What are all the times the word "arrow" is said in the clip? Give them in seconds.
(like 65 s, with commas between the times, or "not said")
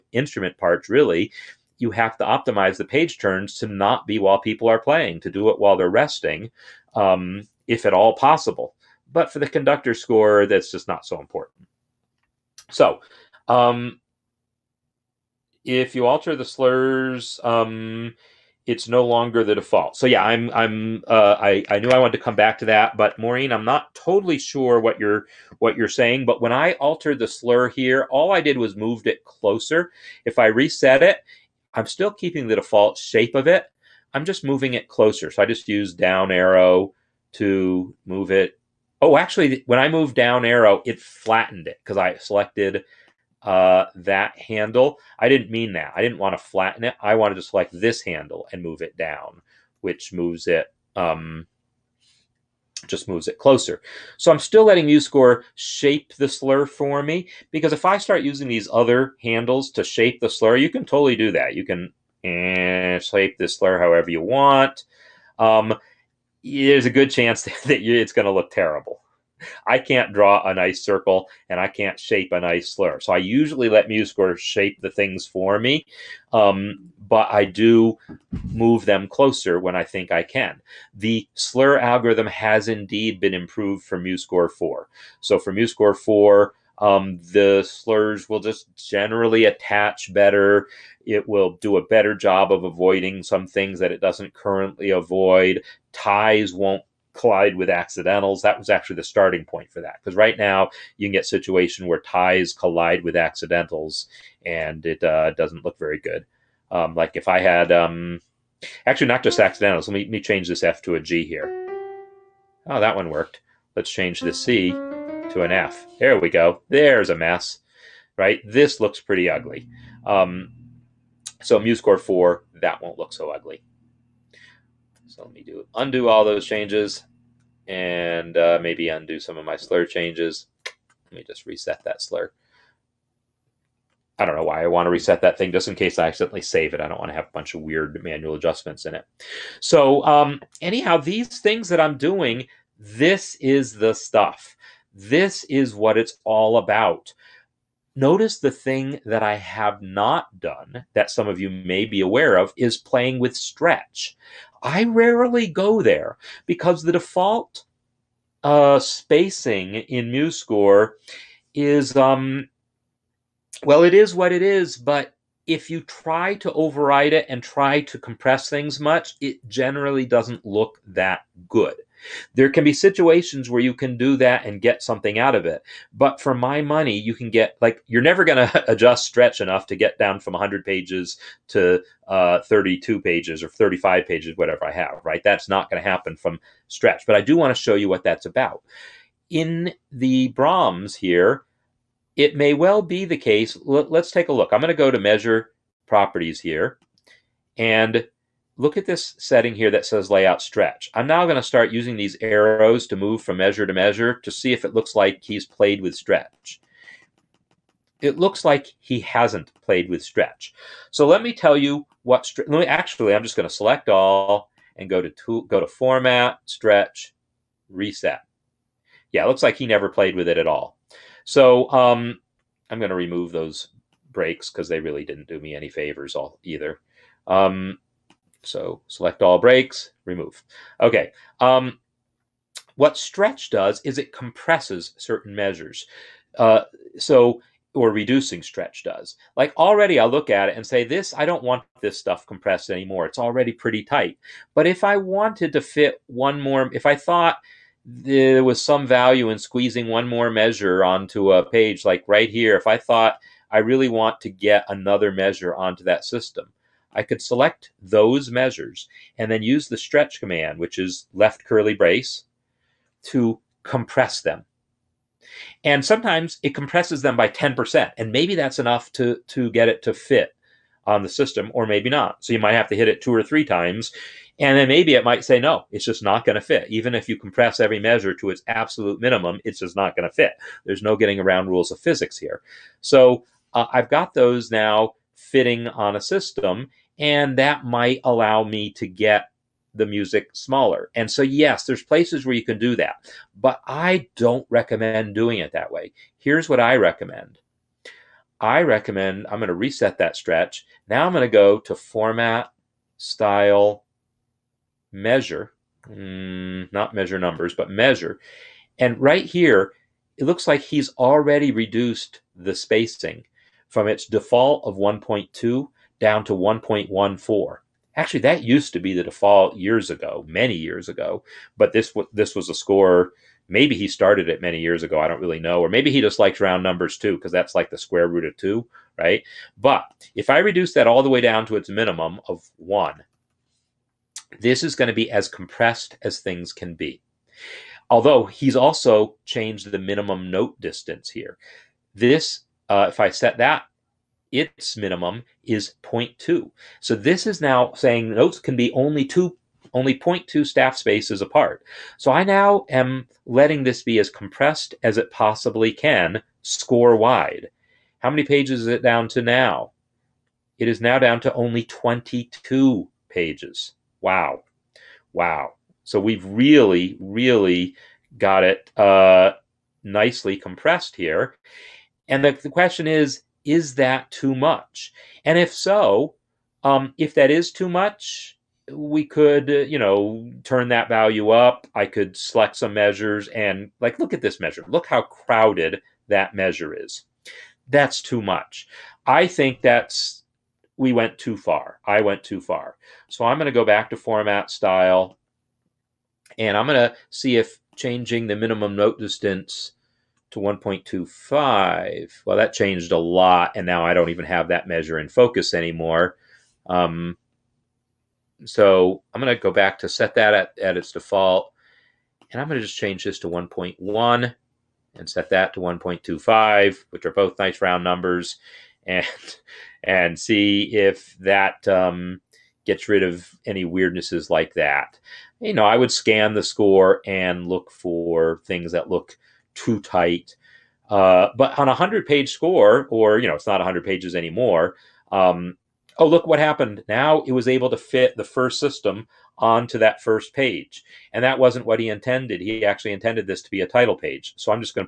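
36 s, 40 s, 202 s.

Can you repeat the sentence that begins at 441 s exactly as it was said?
And that wasn't what he intended.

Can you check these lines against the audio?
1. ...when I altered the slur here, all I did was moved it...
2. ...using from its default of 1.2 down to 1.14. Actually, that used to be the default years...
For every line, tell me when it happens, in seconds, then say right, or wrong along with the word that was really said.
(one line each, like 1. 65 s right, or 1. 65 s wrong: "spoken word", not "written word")
1. 26 s right
2. 312 s wrong: "spacing", not "using".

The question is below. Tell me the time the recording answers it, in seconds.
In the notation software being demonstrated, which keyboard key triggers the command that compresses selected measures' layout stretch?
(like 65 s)
261 s.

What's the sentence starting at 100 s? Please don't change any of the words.
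Because right now you can get situation where ties collide with accidentals and it uh, doesn't look very good.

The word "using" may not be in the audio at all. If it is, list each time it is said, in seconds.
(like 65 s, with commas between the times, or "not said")
58 s, 201 s.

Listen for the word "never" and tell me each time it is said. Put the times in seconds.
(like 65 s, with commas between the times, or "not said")
178 s, 219 s.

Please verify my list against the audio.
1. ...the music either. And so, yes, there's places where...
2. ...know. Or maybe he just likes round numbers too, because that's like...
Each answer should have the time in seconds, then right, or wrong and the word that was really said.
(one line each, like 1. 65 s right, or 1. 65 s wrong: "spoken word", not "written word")
1. 289 s wrong: "smaller", not "either"
2. 325 s right.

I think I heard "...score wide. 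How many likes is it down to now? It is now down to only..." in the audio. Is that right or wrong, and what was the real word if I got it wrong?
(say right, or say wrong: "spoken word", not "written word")
wrong: "pages", not "likes".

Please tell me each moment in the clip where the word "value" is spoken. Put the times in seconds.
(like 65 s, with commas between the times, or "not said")
248 s, 380 s.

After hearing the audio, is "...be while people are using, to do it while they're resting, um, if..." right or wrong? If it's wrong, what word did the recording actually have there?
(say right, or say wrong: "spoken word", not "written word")
wrong: "playing", not "using".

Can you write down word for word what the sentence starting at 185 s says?
That's not going to happen from stretch.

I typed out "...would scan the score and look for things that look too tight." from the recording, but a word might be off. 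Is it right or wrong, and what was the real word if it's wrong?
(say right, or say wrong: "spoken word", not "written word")
right.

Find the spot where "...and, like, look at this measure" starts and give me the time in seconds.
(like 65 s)
383 s.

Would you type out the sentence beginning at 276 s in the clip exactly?
Even if you compress every measure to its absolute minimum, it's just not going to fit.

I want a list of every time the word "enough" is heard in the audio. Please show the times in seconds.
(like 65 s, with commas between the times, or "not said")
179 s, 268 s.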